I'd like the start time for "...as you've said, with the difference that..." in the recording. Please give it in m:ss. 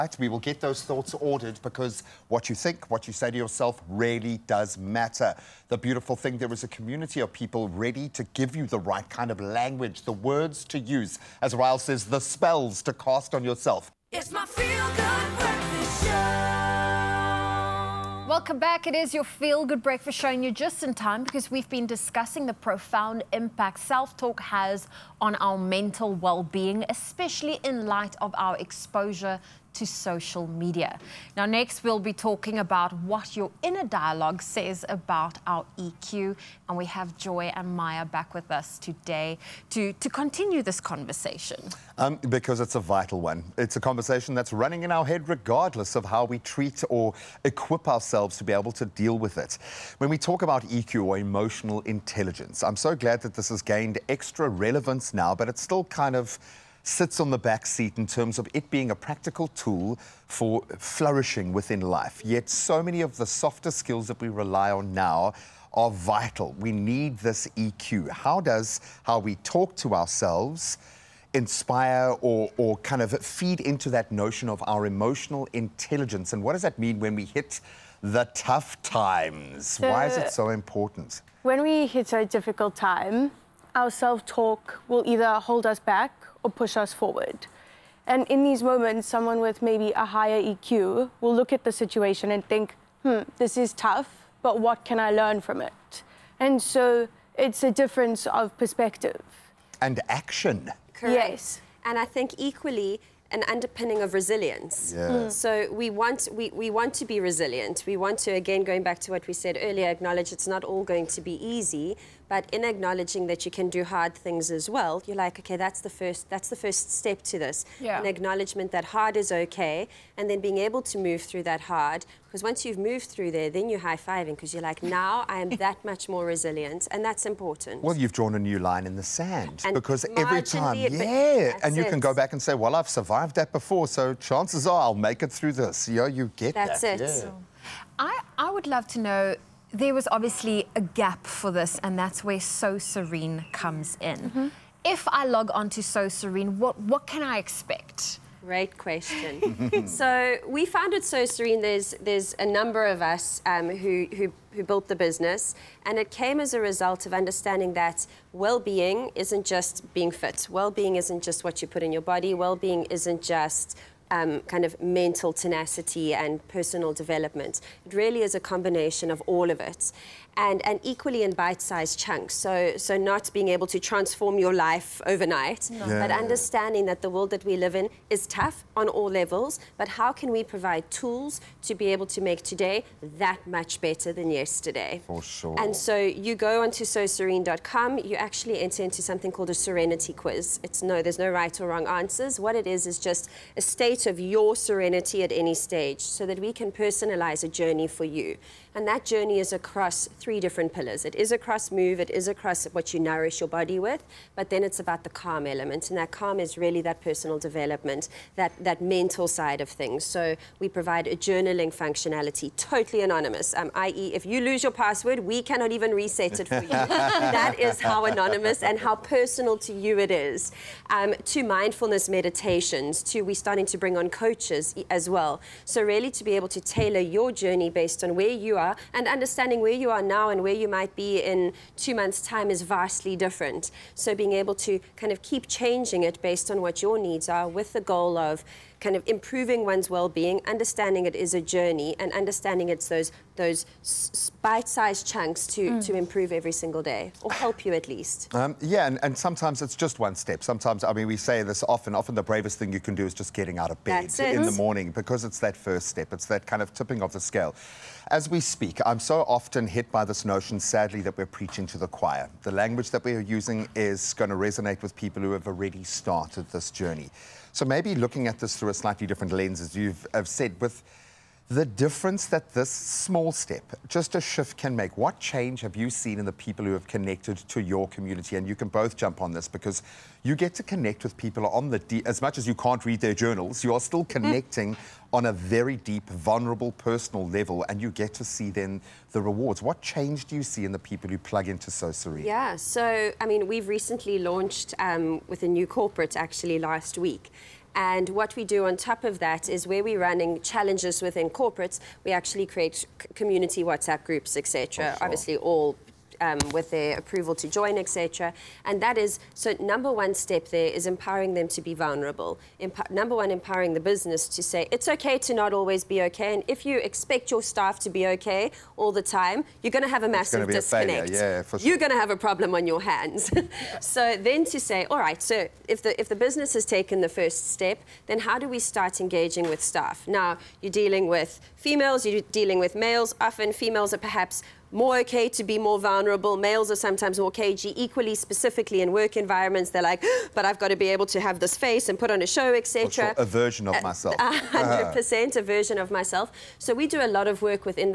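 4:29.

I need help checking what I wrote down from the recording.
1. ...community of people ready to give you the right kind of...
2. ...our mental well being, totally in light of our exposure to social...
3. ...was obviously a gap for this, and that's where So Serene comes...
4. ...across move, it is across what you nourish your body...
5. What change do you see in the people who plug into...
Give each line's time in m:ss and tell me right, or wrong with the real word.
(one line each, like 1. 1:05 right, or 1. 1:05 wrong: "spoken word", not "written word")
1. 0:06 right
2. 0:25 wrong: "especially", not "totally"
3. 2:19 right
4. 3:21 right
5. 4:49 right.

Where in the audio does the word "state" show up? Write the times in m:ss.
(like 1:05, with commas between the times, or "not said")
3:13.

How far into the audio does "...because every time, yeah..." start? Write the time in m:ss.
2:09.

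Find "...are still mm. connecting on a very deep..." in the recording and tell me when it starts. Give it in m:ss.
4:43.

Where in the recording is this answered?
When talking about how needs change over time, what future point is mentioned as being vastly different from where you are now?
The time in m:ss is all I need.
3:51.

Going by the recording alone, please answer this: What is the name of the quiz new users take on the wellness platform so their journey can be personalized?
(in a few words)
serenity quiz.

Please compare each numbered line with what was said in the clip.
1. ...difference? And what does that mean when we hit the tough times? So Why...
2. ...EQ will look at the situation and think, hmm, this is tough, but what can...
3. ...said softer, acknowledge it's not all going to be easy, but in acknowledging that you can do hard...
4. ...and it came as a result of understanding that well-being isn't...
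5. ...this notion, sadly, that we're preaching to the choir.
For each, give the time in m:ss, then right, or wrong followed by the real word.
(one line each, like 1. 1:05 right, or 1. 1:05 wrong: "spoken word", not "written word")
1. 1:15 wrong: "intelligence", not "difference"
2. 1:30 right
3. 1:49 wrong: "earlier", not "softer"
4. 2:35 right
5. 4:20 right.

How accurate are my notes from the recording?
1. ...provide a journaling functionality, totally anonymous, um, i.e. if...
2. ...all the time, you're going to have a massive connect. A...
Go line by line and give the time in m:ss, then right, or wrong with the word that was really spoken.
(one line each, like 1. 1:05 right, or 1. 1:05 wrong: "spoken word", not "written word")
1. 3:30 right
2. 5:18 wrong: "disconnect", not "connect".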